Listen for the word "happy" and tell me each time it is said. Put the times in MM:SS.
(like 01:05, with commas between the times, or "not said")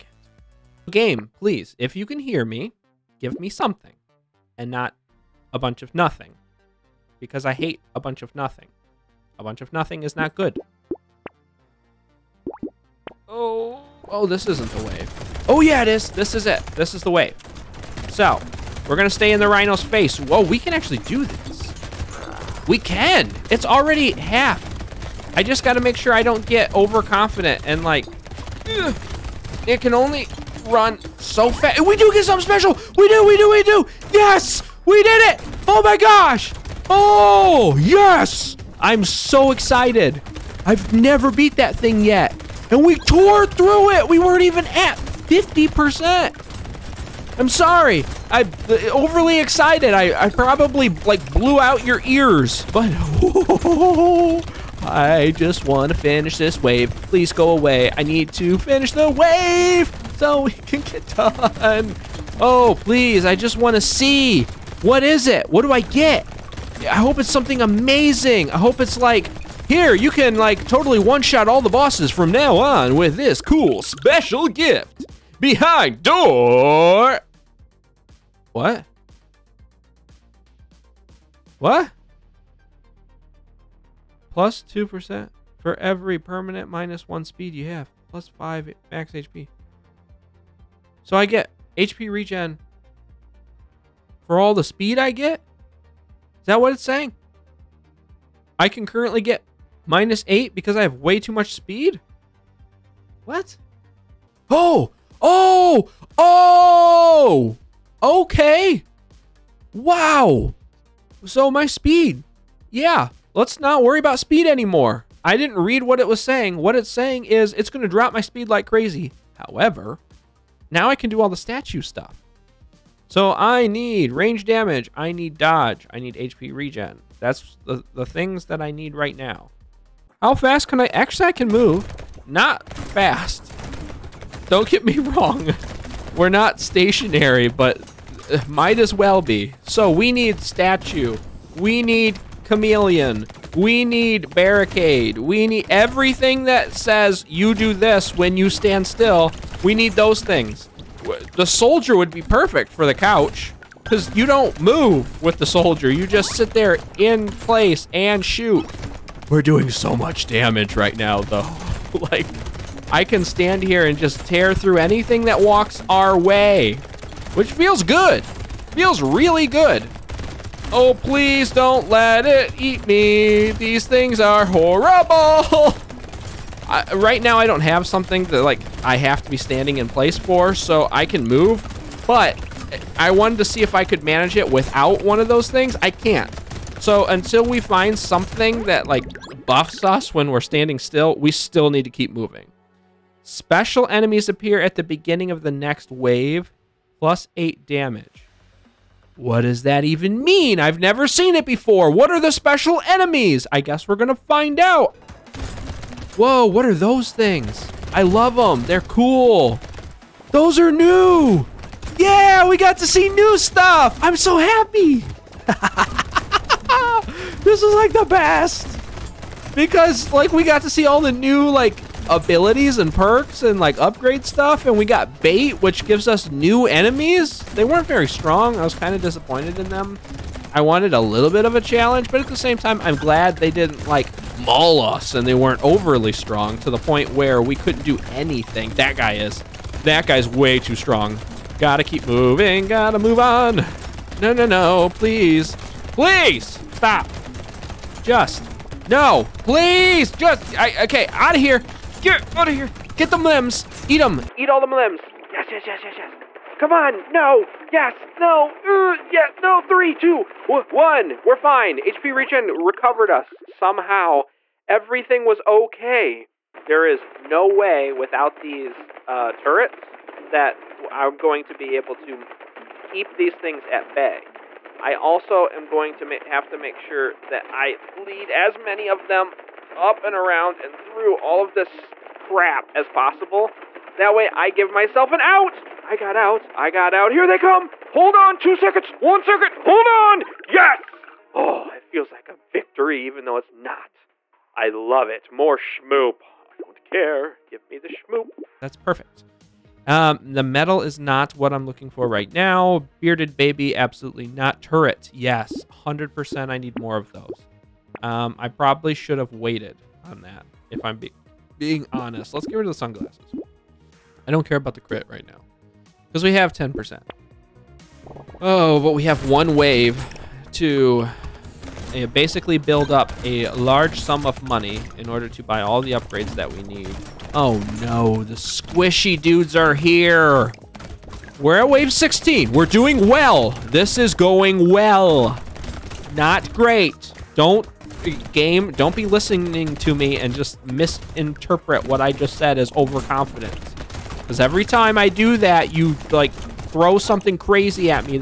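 03:34.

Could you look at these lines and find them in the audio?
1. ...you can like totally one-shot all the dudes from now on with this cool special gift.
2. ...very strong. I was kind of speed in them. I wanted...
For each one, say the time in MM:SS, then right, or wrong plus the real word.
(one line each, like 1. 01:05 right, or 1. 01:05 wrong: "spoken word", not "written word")
1. 01:09 wrong: "bosses", not "dudes"
2. 03:47 wrong: "disappointed", not "speed".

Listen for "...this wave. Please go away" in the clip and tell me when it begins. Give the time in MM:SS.
00:56.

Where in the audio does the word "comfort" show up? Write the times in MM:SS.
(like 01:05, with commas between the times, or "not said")
not said.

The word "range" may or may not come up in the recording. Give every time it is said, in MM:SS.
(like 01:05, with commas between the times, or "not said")
02:04.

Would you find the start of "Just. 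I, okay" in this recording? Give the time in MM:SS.
04:10.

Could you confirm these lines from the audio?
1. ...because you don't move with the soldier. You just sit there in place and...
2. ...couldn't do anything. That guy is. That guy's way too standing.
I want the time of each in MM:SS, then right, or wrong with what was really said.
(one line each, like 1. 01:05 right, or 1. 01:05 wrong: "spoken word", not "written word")
1. 02:33 right
2. 03:57 wrong: "strong", not "standing".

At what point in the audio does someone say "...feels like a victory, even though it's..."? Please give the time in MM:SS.
04:51.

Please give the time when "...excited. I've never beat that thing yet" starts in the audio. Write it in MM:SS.
00:39.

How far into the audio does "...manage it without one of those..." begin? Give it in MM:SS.
03:04.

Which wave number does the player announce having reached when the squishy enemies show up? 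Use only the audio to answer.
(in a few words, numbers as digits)
16.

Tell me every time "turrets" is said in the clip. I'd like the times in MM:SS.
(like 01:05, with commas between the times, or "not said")
04:29, 05:04.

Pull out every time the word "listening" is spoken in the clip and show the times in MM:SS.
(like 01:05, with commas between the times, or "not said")
05:39.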